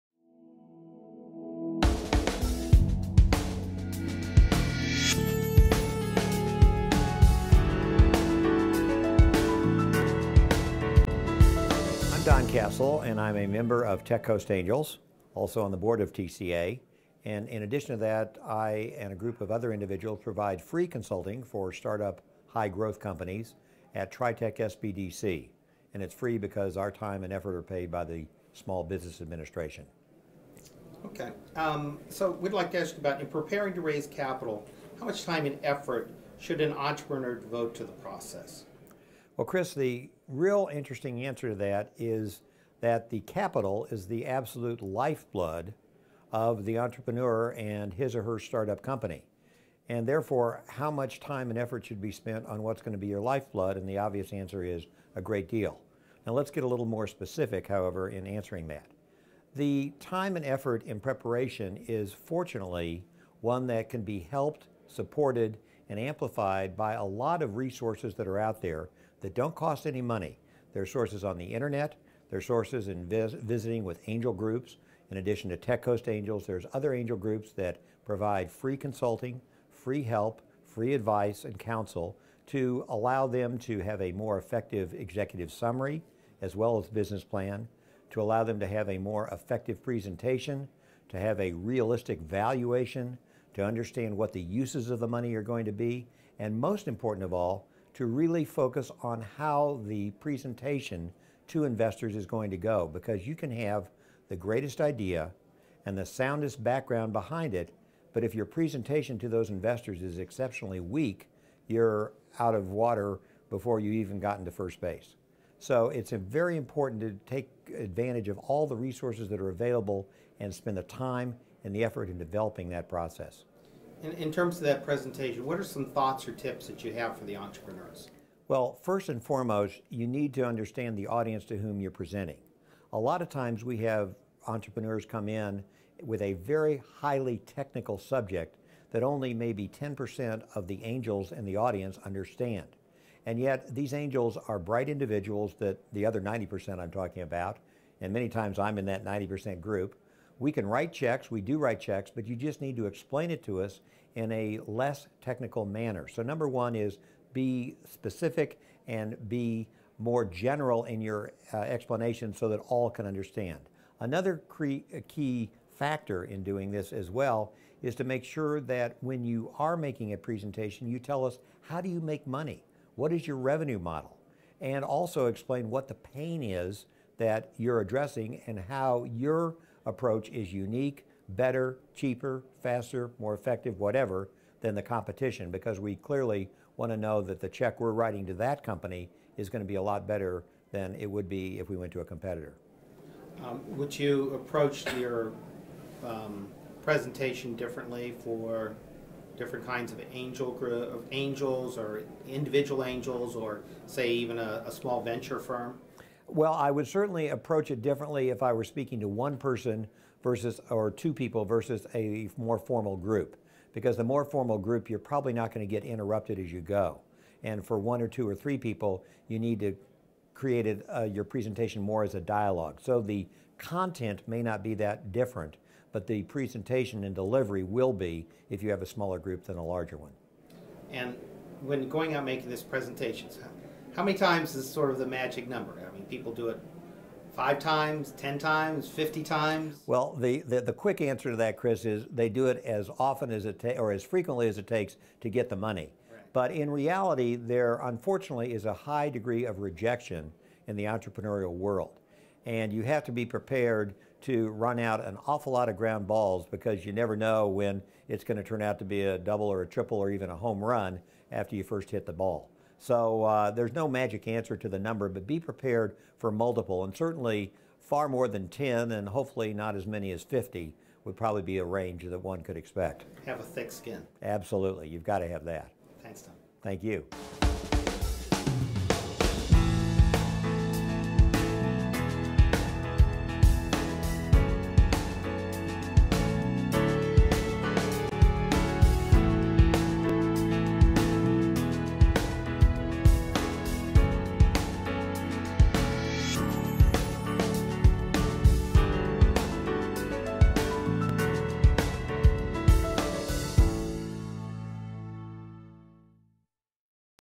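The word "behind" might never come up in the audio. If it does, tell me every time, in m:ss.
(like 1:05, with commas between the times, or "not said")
1:47.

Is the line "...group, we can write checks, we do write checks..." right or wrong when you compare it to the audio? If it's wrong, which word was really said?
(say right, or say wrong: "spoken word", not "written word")
right.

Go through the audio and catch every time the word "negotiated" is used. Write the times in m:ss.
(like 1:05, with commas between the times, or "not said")
not said.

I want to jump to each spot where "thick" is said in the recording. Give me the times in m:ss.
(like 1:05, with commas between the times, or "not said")
4:33.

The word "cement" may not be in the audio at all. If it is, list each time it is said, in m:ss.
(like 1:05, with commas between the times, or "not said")
not said.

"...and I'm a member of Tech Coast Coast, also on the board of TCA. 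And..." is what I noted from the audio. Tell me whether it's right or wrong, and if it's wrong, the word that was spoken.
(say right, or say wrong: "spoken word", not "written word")
wrong: "Angels", not "Coast".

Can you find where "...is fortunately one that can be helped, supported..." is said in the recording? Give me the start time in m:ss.
1:01.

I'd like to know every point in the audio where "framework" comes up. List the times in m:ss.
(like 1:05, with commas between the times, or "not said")
not said.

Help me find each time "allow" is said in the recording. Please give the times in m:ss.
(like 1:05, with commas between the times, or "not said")
1:22, 1:28.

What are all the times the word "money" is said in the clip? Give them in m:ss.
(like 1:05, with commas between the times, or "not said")
1:10, 1:35, 2:52, 4:05.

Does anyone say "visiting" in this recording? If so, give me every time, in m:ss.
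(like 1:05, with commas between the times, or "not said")
1:13.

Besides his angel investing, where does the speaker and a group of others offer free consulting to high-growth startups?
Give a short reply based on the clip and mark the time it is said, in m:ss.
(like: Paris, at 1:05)
Tritech SBDC, at 0:24.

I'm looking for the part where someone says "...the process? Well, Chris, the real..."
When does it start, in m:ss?
0:37.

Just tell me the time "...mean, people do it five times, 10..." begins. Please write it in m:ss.
3:55.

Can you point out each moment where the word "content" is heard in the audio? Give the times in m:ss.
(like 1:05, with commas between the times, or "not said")
3:43.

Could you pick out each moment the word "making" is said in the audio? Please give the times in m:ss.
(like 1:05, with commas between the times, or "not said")
2:49, 3:52.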